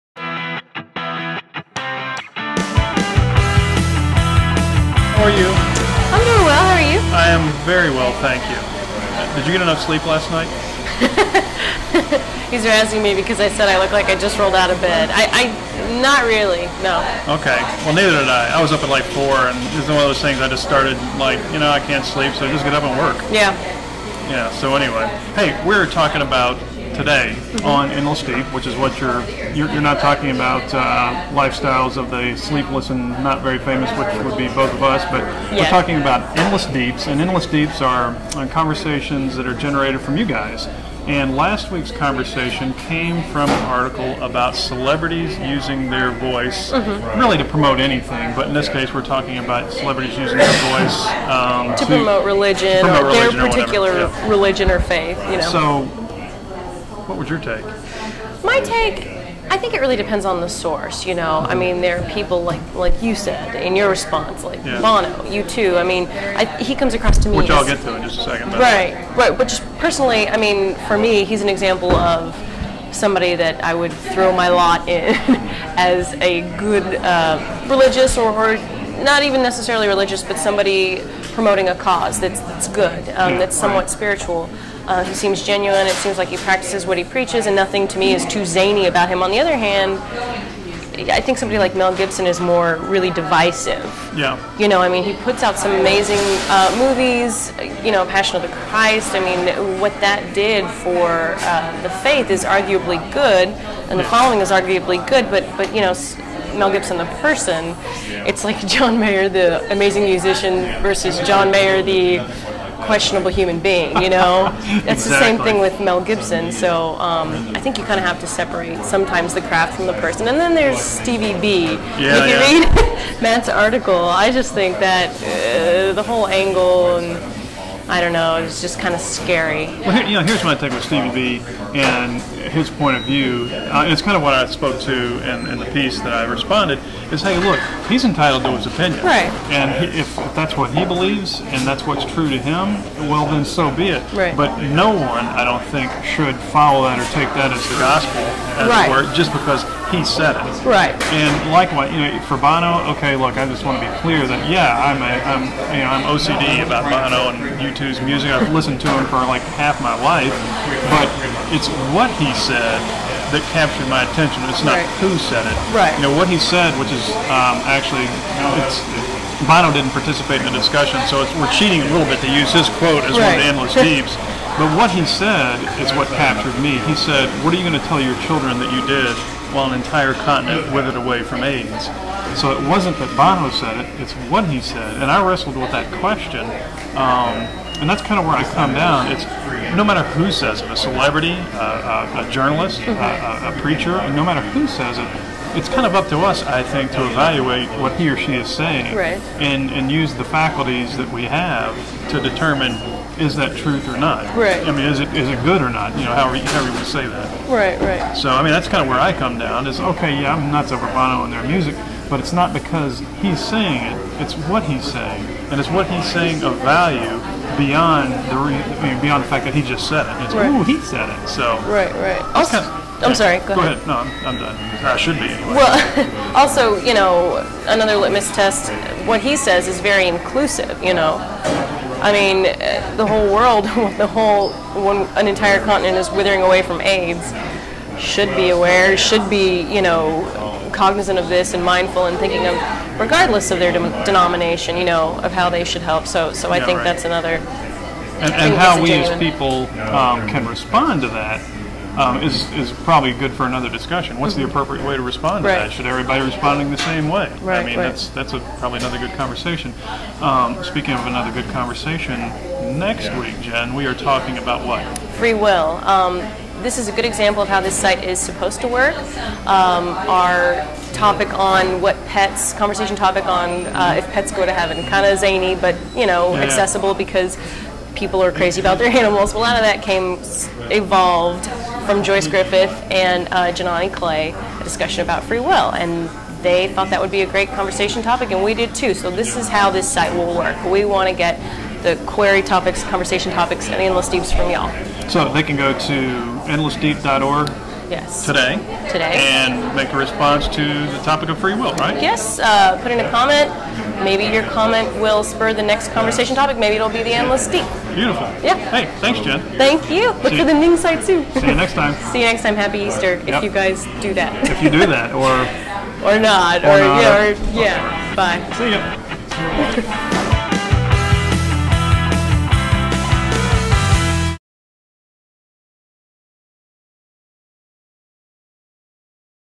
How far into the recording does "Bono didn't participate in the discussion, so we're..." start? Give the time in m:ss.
2:49.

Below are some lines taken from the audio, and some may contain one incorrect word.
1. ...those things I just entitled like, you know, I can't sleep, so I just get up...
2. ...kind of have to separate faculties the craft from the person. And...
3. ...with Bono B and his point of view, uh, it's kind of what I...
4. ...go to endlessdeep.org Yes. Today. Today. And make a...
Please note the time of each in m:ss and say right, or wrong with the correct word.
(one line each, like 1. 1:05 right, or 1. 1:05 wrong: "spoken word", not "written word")
1. 0:20 wrong: "started", not "entitled"
2. 1:57 wrong: "sometimes", not "faculties"
3. 2:10 wrong: "Stevie", not "Bono"
4. 4:55 right.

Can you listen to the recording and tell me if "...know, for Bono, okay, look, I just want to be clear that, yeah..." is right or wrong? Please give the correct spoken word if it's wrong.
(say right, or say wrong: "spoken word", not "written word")
right.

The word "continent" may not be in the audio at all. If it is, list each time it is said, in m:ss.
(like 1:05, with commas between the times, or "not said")
3:00, 3:55.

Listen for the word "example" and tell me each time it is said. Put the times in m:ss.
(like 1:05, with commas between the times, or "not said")
1:11, 4:27.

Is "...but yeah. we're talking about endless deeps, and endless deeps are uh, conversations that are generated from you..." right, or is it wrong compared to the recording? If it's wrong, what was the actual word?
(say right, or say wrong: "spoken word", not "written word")
right.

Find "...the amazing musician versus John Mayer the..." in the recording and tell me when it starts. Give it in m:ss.
1:49.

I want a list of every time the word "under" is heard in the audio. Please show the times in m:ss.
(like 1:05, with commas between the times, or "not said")
not said.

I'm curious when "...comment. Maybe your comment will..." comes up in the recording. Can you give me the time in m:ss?
5:03.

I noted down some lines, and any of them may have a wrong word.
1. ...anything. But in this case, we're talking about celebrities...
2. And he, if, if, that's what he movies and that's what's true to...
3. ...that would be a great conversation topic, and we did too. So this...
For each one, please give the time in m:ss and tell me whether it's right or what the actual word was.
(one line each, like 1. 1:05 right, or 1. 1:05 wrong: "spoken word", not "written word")
1. 0:47 right
2. 2:19 wrong: "believes", not "movies"
3. 4:46 right.